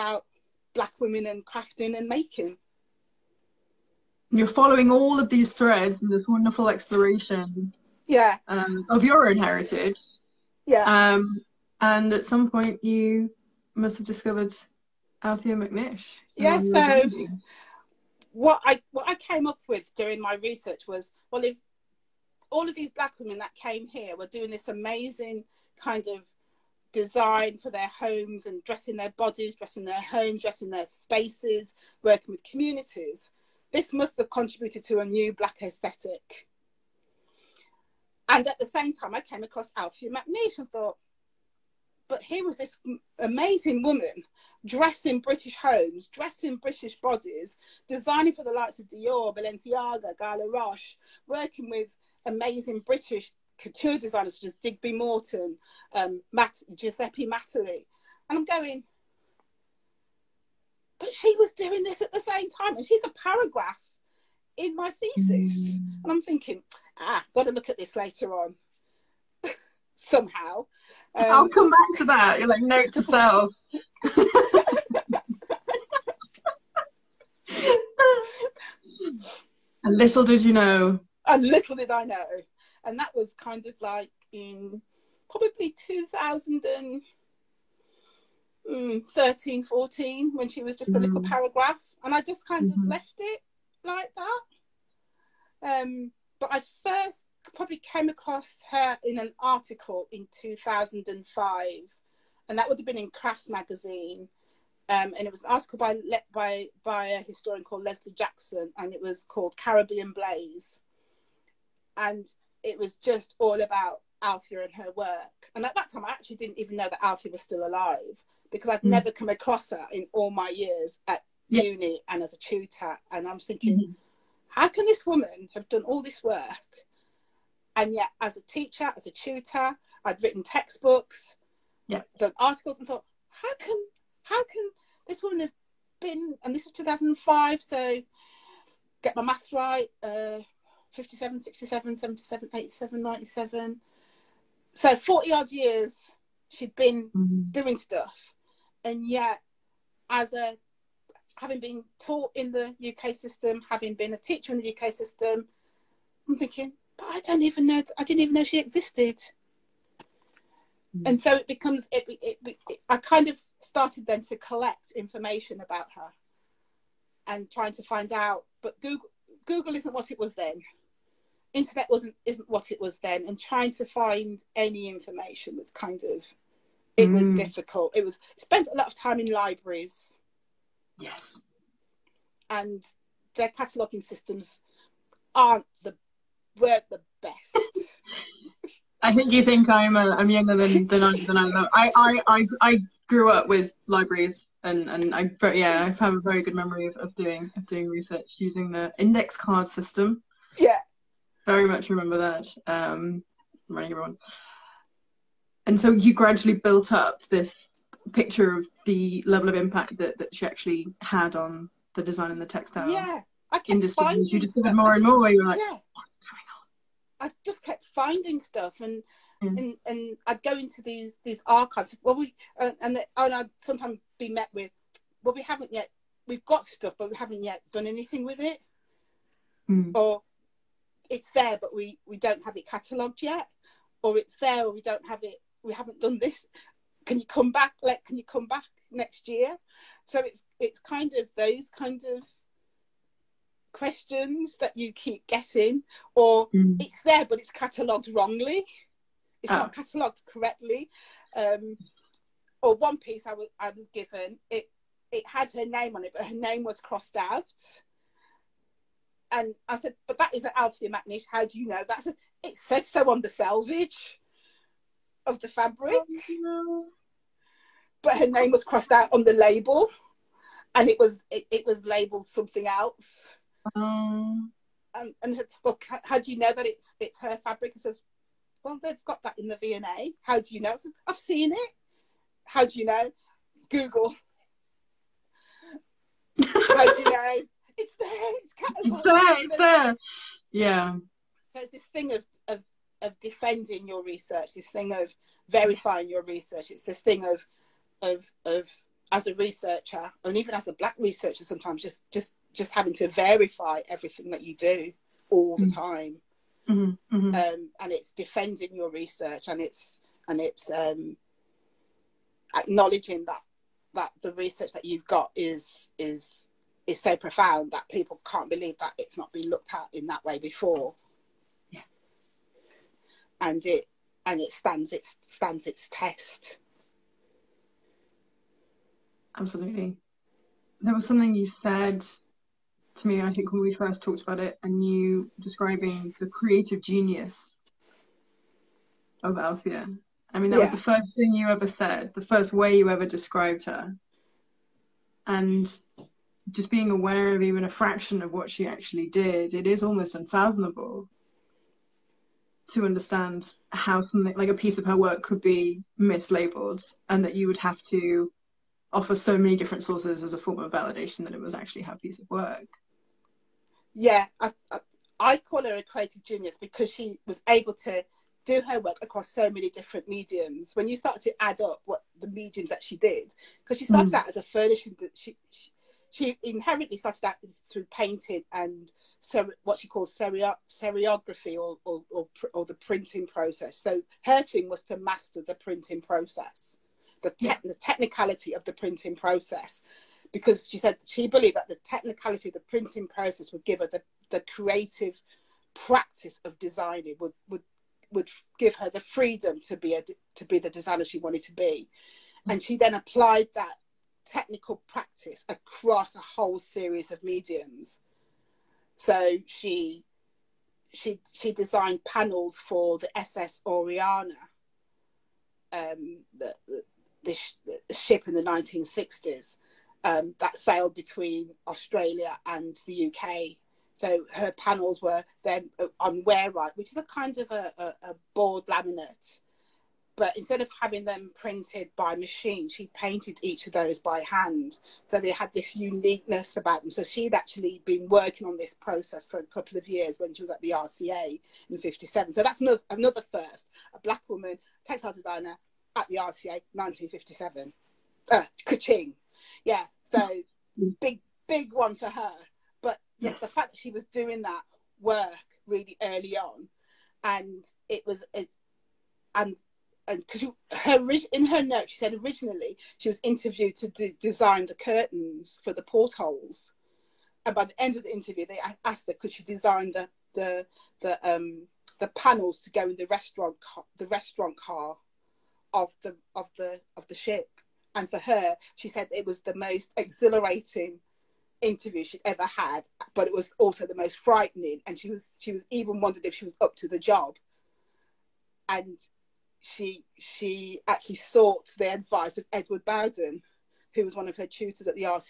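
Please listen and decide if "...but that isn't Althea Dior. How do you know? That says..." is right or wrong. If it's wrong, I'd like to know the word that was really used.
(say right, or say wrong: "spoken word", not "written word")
wrong: "McNish", not "Dior".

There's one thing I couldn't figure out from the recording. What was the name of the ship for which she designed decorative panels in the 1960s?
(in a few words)
SS Oriana.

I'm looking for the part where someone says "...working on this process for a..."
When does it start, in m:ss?
7:18.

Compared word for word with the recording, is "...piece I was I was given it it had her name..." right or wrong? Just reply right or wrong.
right.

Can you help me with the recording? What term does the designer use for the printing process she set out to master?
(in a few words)
seriography.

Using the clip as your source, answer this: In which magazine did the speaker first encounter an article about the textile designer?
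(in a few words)
Crafts magazine.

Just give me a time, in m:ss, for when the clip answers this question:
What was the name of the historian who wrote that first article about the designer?
1:47.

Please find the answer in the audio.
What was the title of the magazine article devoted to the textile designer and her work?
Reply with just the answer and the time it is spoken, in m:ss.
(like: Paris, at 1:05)
Caribbean Blaze, at 1:49.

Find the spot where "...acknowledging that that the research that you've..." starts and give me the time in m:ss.
5:12.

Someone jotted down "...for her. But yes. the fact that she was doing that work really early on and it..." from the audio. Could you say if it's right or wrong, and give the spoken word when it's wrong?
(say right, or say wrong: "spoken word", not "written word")
right.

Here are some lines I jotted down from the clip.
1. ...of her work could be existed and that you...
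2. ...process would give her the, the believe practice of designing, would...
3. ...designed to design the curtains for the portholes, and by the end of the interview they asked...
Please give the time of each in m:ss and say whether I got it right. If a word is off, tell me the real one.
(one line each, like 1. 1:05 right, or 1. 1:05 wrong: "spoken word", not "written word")
1. 5:54 wrong: "mislabeled", not "existed"
2. 6:33 wrong: "creative", not "believe"
3. 7:43 wrong: "interviewed", not "designed".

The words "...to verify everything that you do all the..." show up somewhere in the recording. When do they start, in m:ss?
5:02.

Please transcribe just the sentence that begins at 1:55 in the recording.
And at that time, I actually didn't even know that Althea was still alive because I'd mm.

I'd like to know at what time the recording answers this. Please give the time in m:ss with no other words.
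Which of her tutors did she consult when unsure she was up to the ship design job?
8:12.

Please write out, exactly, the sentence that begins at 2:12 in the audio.
done articles, and thought, how can how can this woman have been?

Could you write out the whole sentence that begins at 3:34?
Finding you more and more where you're like, yeah.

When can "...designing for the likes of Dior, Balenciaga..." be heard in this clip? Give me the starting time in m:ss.
0:47.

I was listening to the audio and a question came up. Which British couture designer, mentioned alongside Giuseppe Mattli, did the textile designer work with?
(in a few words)
Digby Morton.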